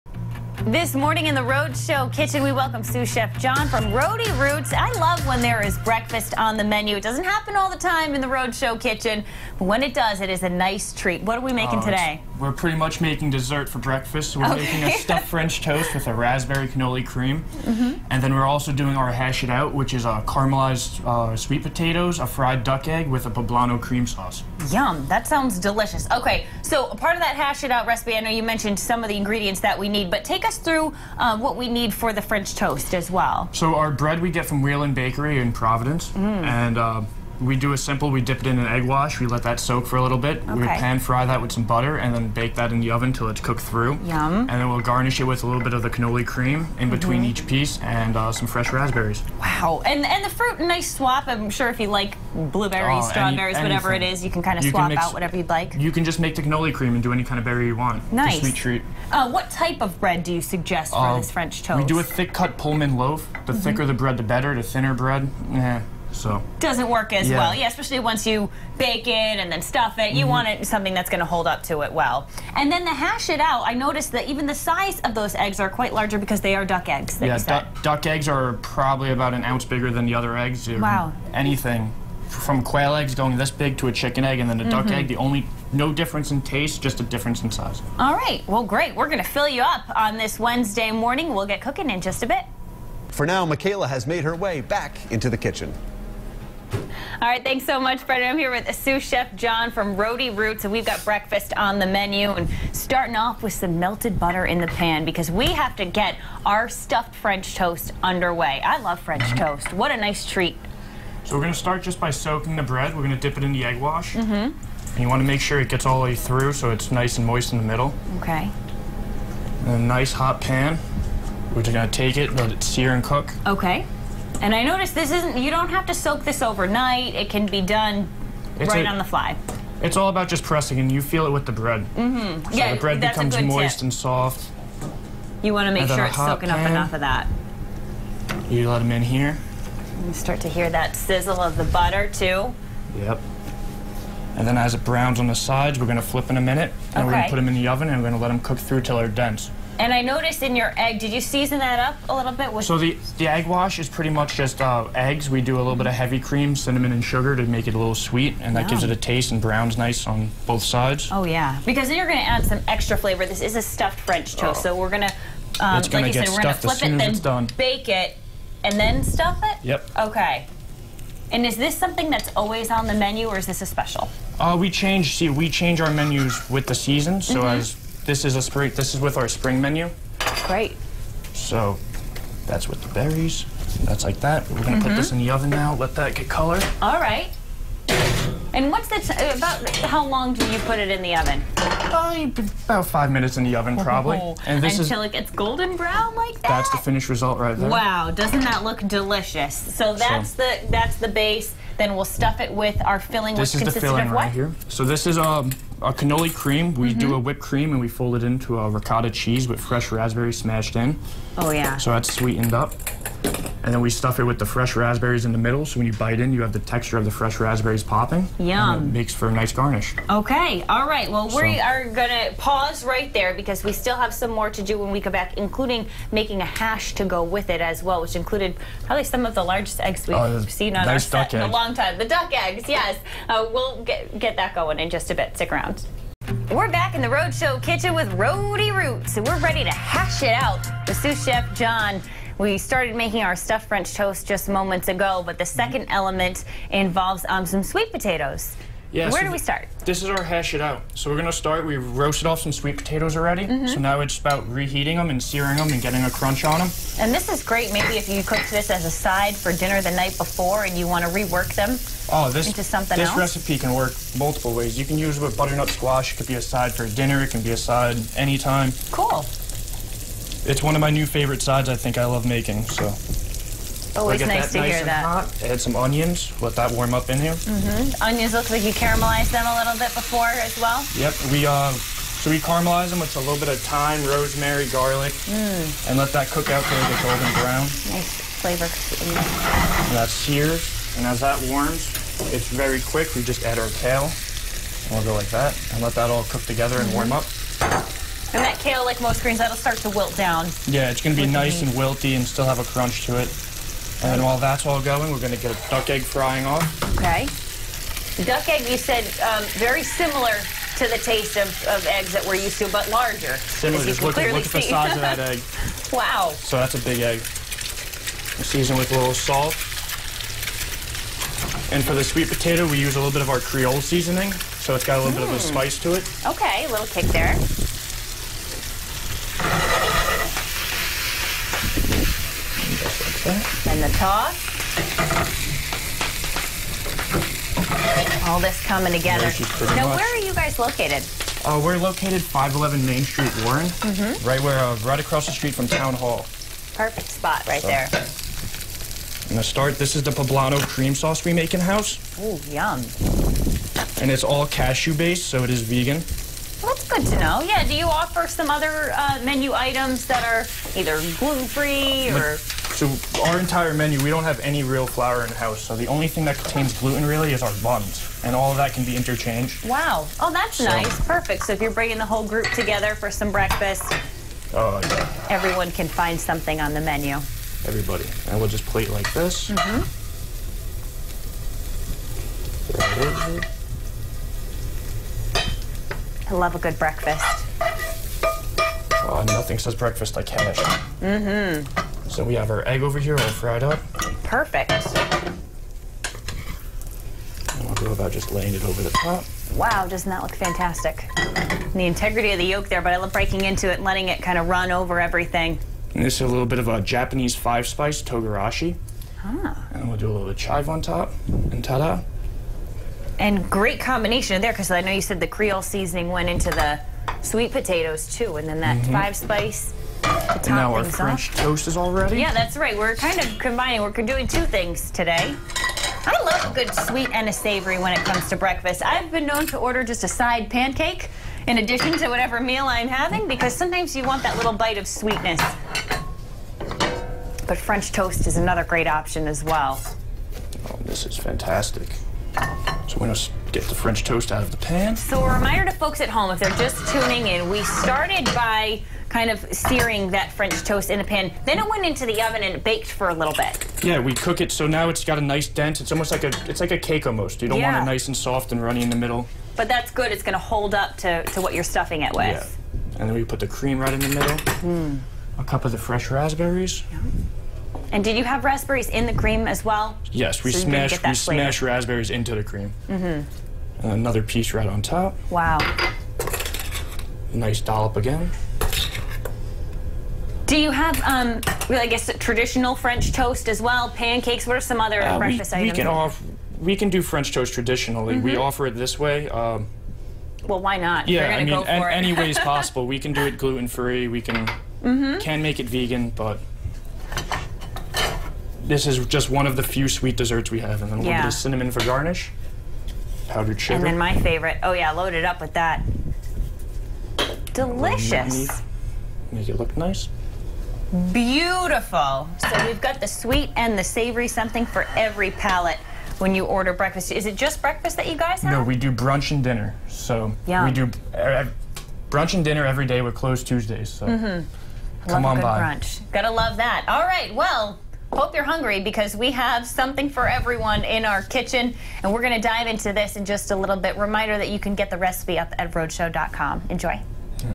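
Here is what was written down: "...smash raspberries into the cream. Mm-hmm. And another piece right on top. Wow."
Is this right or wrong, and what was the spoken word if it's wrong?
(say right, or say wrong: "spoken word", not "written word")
right.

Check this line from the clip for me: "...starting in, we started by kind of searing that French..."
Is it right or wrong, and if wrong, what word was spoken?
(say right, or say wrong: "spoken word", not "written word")
wrong: "tuning", not "starting".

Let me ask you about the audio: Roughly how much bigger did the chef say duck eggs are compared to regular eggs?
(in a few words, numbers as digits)
About an ounce.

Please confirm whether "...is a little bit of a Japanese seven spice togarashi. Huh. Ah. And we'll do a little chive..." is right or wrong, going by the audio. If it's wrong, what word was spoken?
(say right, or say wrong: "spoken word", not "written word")
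wrong: "five", not "seven".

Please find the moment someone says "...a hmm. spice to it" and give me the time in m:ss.
5:25.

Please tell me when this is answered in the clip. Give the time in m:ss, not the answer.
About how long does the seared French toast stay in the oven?
3:12.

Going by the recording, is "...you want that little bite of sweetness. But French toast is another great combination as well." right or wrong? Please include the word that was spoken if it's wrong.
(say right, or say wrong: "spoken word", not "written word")
wrong: "option", not "combination".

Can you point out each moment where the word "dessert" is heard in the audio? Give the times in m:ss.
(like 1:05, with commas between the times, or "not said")
0:13, 8:20.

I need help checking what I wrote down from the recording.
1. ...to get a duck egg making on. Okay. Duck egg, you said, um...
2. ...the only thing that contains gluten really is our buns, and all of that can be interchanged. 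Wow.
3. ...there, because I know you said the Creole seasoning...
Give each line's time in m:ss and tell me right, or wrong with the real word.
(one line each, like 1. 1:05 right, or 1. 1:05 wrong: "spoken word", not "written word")
1. 5:05 wrong: "frying", not "making"
2. 6:05 right
3. 6:54 right.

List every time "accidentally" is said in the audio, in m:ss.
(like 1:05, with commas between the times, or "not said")
not said.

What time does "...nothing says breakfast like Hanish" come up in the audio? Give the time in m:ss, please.
6:29.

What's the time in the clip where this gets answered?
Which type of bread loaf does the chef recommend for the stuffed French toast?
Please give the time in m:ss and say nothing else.
1:02.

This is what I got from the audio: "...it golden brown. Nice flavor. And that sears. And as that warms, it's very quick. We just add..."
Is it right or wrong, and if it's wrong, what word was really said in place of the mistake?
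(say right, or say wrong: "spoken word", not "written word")
right.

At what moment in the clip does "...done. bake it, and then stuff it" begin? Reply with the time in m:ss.
2:47.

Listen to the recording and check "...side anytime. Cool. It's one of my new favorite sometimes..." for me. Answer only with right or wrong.
wrong.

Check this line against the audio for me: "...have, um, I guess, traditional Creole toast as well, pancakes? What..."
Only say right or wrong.
wrong.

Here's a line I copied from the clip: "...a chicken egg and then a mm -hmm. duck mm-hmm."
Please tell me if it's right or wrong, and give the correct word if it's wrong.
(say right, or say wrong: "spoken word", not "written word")
right.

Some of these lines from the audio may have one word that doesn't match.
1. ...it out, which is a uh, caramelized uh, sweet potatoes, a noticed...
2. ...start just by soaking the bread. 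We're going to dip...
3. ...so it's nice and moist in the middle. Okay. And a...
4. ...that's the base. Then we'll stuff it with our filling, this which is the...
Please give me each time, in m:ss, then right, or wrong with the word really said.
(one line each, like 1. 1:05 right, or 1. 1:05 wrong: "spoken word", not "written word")
1. 0:19 wrong: "fried", not "noticed"
2. 1:51 right
3. 1:56 right
4. 3:20 right.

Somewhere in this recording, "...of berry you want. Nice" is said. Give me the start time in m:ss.
0:57.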